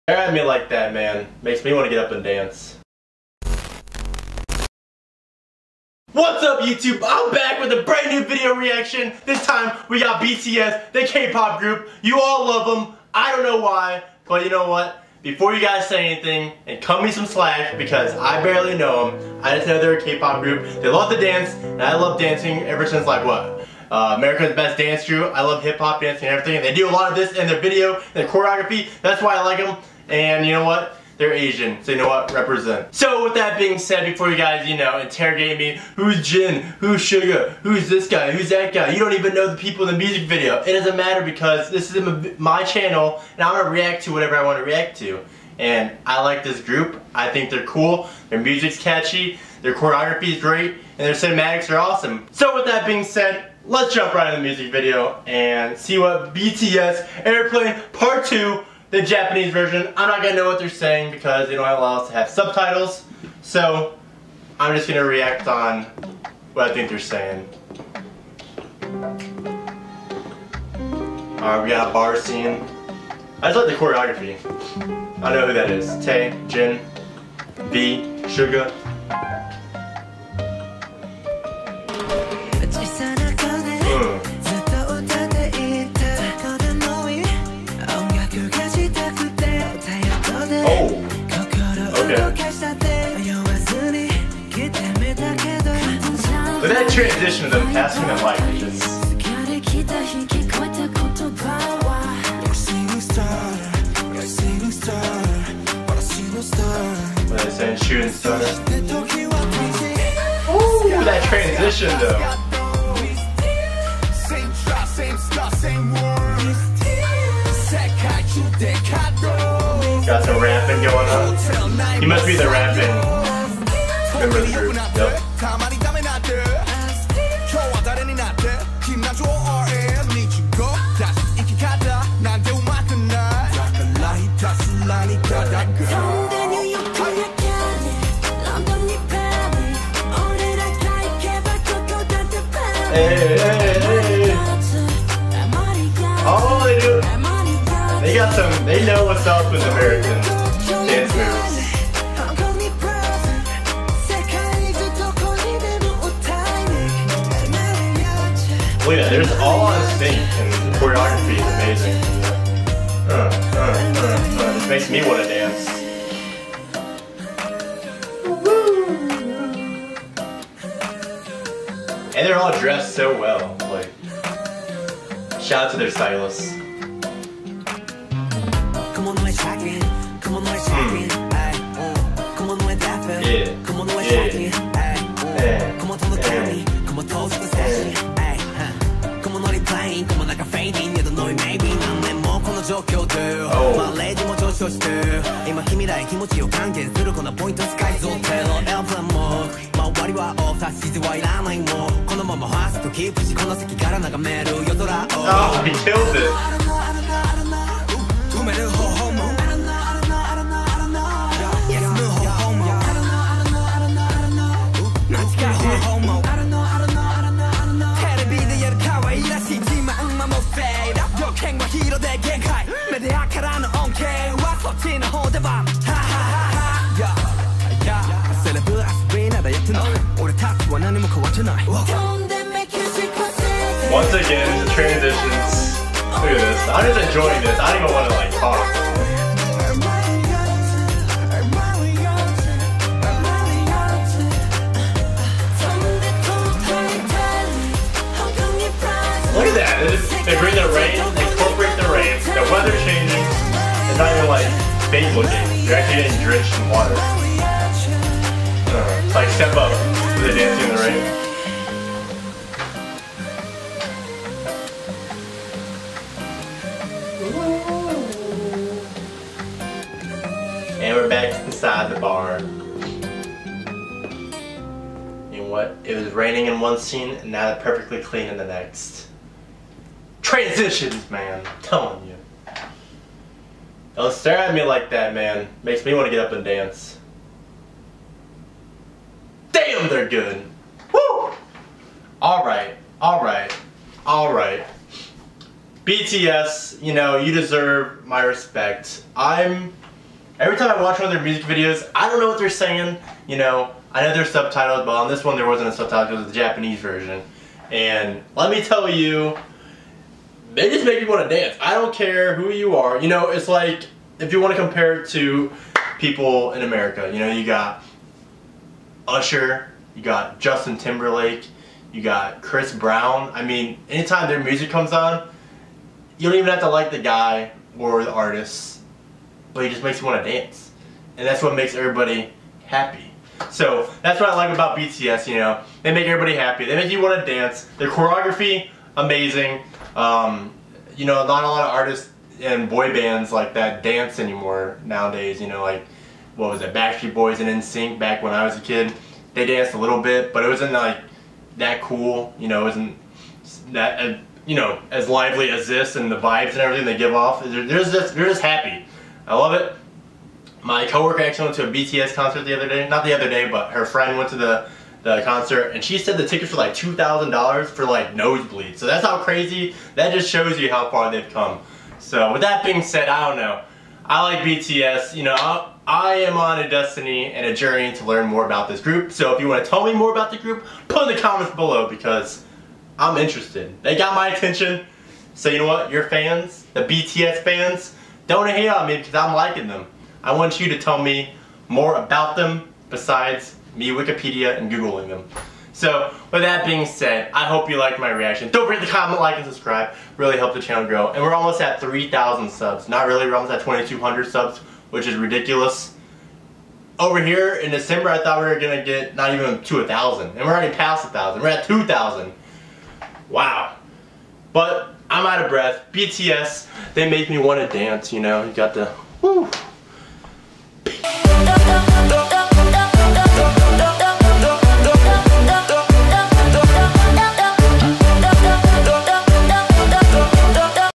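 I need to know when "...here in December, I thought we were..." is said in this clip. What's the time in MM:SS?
06:47.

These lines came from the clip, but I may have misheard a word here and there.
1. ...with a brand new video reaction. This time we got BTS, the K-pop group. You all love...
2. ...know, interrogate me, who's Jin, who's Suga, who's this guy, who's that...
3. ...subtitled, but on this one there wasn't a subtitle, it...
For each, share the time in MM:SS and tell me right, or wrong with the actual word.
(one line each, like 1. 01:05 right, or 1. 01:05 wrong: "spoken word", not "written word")
1. 00:07 right
2. 00:34 right
3. 05:04 right.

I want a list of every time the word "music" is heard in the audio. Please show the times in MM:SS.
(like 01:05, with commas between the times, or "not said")
00:39, 00:48, 00:54, 05:01, 05:24.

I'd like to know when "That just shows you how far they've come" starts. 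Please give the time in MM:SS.
06:09.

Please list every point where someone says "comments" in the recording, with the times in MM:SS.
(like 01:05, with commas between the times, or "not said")
06:21, 06:38.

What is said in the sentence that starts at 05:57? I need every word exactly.
They're, they're just they're just happy.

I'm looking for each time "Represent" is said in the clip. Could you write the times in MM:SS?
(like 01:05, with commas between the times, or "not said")
00:32.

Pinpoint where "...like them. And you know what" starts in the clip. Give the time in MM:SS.
00:29.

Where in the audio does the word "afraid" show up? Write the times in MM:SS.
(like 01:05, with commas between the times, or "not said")
not said.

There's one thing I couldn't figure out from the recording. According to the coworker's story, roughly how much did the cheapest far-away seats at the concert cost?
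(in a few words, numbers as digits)
$2,000.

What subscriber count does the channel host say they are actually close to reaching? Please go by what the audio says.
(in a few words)
2,200.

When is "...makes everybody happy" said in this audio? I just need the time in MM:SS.
05:31.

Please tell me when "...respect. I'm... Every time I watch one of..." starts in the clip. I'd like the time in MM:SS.
04:58.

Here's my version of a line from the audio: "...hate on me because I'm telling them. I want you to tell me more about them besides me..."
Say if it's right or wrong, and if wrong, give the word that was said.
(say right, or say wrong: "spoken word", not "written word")
wrong: "liking", not "telling".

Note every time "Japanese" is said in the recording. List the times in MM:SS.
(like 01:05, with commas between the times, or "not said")
00:59, 05:06.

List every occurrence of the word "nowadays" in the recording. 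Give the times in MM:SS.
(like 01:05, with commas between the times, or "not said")
05:44.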